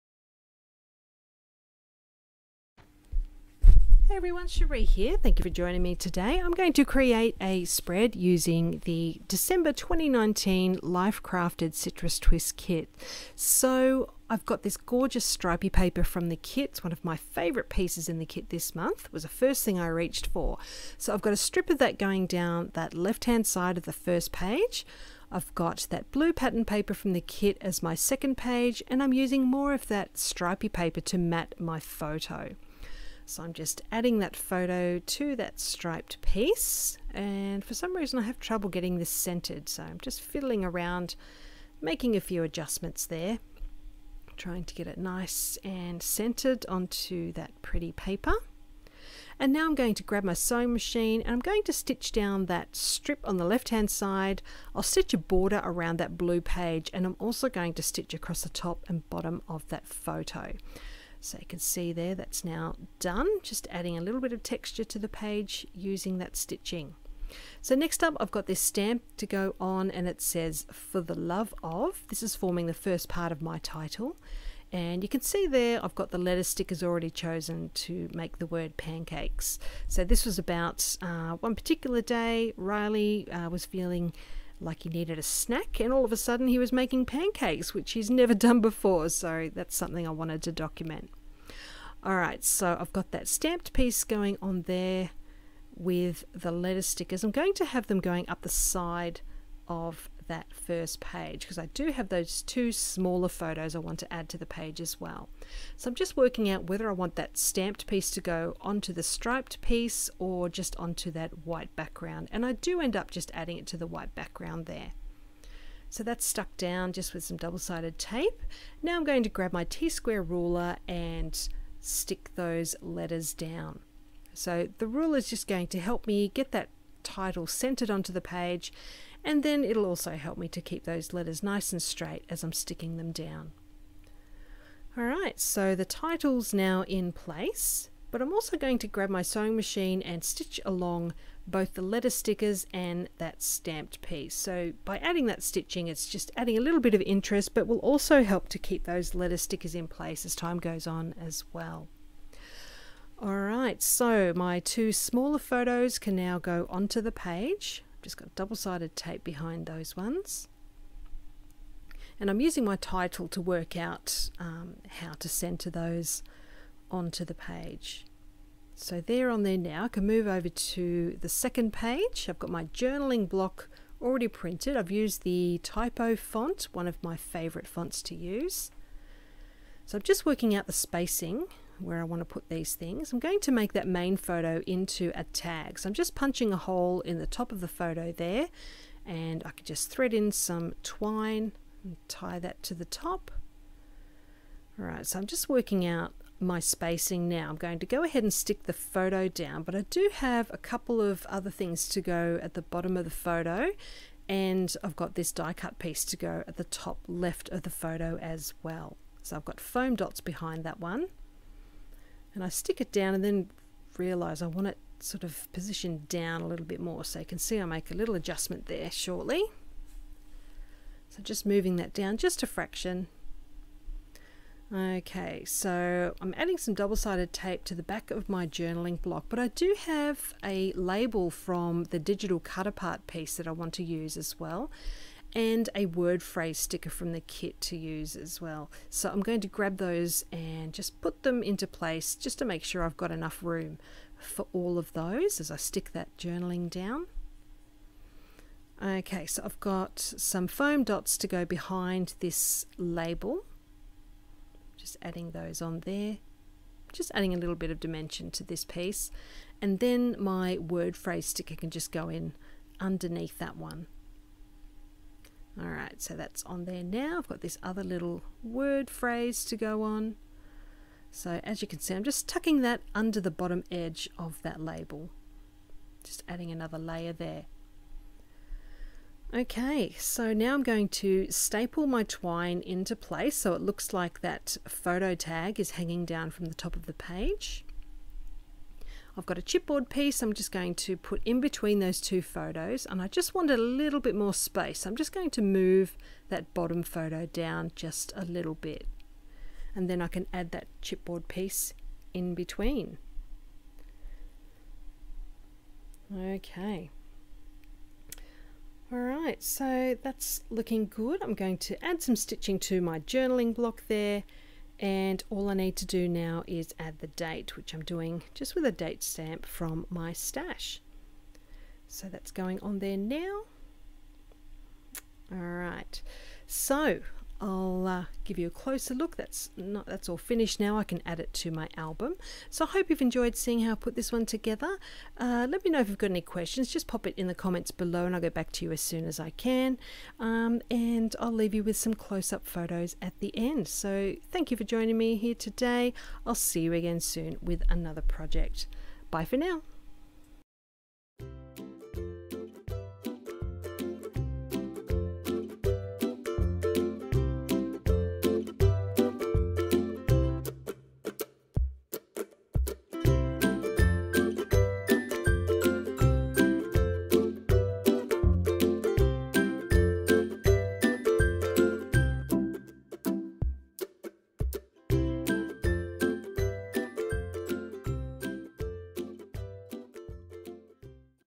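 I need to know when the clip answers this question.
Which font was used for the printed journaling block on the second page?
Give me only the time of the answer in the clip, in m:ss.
2:55.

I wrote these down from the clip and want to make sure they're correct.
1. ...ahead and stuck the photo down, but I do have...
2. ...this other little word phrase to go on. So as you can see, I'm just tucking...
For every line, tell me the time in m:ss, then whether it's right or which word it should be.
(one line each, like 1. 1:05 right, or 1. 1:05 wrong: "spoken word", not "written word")
1. 3:18 wrong: "stick", not "stuck"
2. 4:27 right.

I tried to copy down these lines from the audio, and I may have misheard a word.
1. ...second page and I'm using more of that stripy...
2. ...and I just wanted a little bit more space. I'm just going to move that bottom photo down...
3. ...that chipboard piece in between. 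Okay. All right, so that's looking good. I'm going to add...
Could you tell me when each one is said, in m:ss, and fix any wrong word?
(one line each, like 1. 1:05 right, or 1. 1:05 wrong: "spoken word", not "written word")
1. 0:27 right
2. 4:52 right
3. 5:00 right.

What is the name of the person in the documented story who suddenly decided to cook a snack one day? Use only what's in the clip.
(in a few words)
Riley.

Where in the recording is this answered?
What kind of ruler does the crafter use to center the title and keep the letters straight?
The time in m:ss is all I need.
1:59.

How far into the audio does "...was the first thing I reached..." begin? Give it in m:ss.
0:19.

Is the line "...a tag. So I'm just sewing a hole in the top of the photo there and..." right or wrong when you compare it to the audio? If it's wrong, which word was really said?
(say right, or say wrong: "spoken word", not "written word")
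wrong: "punching", not "sewing".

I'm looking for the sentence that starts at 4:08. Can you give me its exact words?
Okay, so I've got some foam dots to go behind this label.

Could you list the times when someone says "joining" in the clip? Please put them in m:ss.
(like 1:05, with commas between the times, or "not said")
0:05, 5:44.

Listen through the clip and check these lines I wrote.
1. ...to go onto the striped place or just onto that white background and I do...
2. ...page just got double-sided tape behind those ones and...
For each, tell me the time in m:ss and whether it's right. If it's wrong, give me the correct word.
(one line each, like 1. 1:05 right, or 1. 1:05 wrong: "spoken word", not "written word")
1. 1:48 wrong: "piece", not "place"
2. 2:37 right.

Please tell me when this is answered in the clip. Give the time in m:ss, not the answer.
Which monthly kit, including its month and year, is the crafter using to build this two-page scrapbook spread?
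0:09.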